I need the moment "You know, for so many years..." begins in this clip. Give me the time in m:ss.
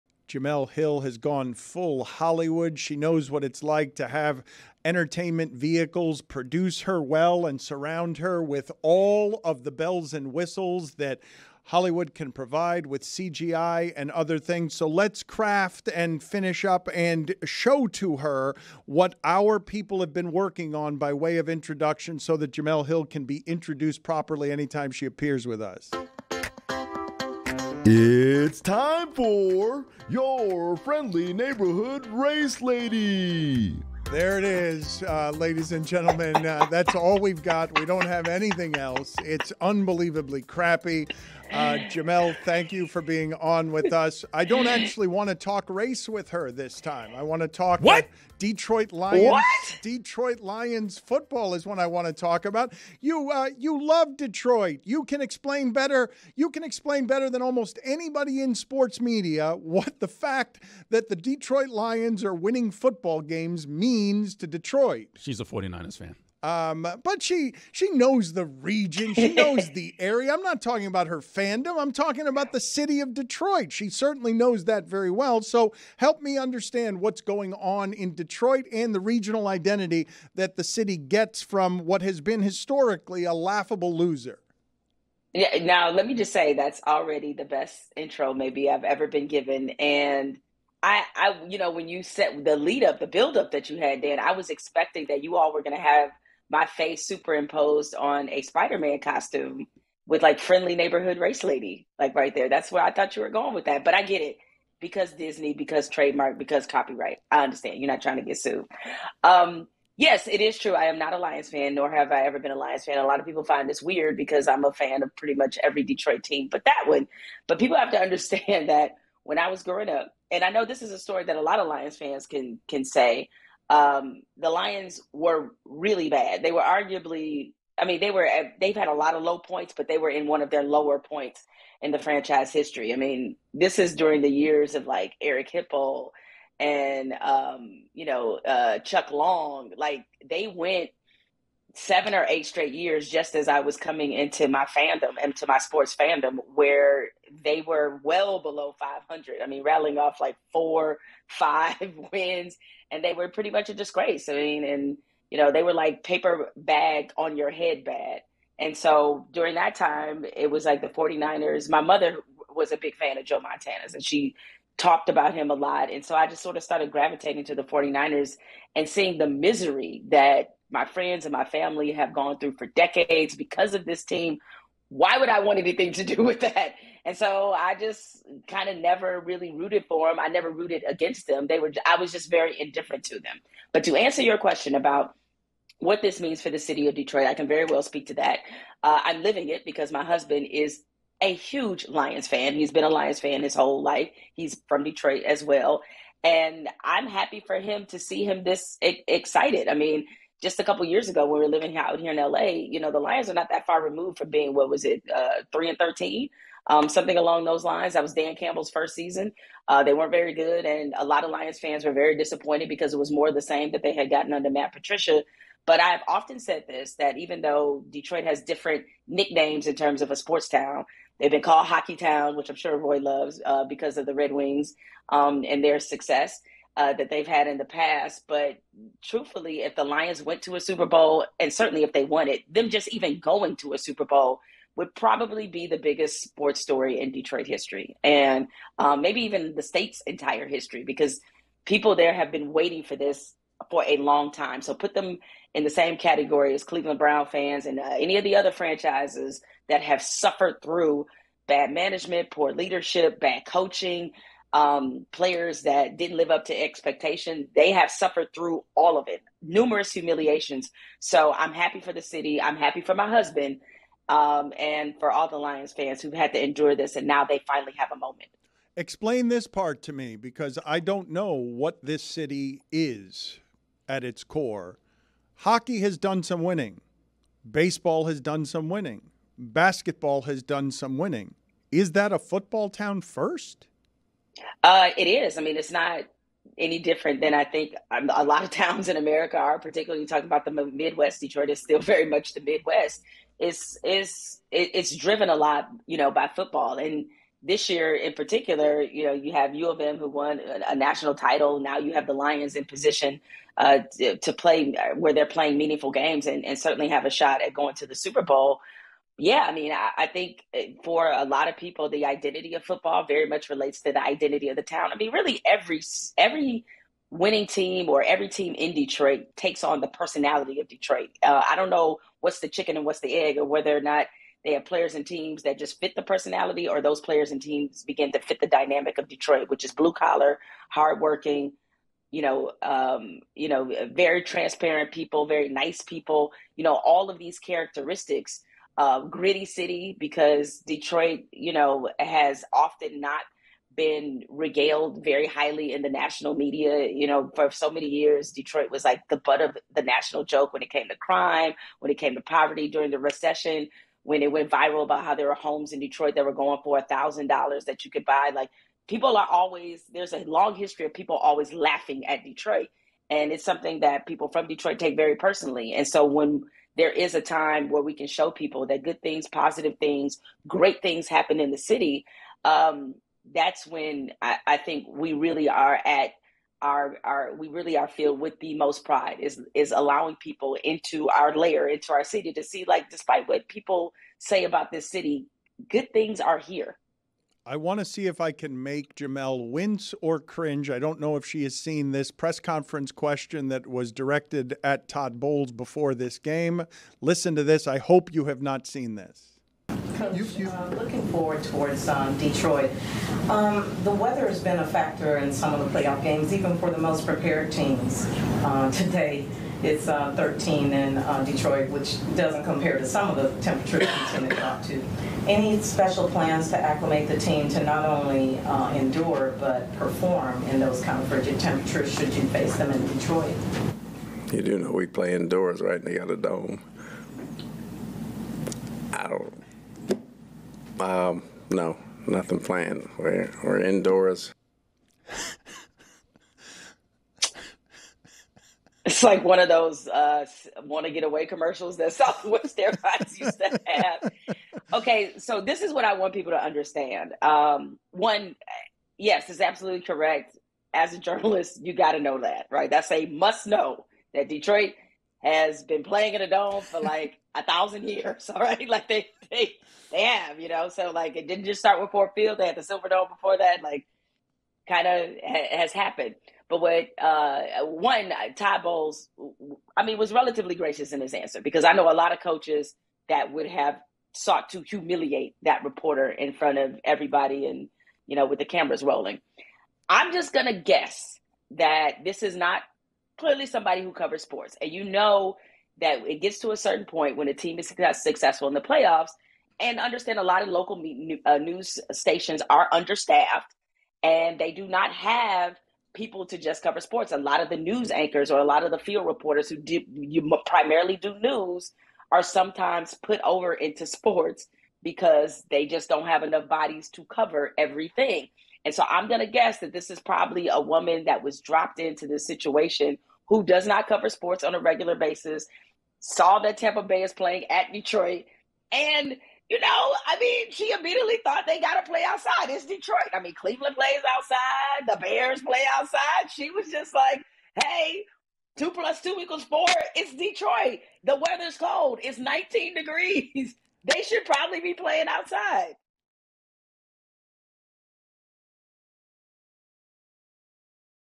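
5:46.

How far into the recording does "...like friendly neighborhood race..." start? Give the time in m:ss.
1:40.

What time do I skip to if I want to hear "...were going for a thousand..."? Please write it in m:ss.
5:56.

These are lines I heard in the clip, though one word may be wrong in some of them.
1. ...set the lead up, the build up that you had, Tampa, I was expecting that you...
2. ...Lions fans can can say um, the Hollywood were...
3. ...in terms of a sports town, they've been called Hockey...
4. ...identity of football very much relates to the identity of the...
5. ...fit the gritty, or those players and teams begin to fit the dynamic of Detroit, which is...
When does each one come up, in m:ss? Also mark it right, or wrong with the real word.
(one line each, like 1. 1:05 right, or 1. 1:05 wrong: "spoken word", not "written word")
1. 1:32 wrong: "Dan", not "Tampa"
2. 2:01 wrong: "Lions", not "Hollywood"
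3. 3:39 right
4. 5:12 right
5. 5:25 wrong: "personality", not "gritty".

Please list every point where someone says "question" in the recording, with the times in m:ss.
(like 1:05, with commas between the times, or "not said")
3:04, 6:32.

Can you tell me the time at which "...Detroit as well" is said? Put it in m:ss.
3:14.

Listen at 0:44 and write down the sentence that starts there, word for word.
I don't actually want to talk race with her this time.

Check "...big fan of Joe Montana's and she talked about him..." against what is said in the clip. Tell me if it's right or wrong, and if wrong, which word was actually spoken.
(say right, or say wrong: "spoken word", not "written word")
right.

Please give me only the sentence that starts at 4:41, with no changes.
Is that a football town first?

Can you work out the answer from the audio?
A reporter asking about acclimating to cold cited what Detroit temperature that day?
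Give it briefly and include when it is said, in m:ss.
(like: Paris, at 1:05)
13 degrees, at 6:50.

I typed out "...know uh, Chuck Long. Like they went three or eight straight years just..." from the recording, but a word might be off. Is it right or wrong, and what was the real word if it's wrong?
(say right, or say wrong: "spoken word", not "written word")
wrong: "seven", not "three".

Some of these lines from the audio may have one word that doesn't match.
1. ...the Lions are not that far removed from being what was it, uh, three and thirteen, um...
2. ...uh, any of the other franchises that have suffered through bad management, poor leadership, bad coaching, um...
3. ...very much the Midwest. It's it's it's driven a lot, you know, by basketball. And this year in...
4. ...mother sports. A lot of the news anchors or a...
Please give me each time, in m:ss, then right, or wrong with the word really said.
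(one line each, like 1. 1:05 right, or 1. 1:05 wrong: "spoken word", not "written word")
1. 3:22 right
2. 4:07 right
3. 4:51 wrong: "football", not "basketball"
4. 8:16 wrong: "cover", not "mother".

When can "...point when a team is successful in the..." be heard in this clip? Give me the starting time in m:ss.
8:06.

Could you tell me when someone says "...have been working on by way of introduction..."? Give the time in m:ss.
0:19.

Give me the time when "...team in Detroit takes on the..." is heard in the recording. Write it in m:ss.
5:18.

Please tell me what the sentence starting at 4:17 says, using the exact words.
They have suffered through all of it, numerous humiliations.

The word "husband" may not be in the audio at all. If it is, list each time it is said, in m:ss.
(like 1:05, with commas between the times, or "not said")
3:10, 4:23.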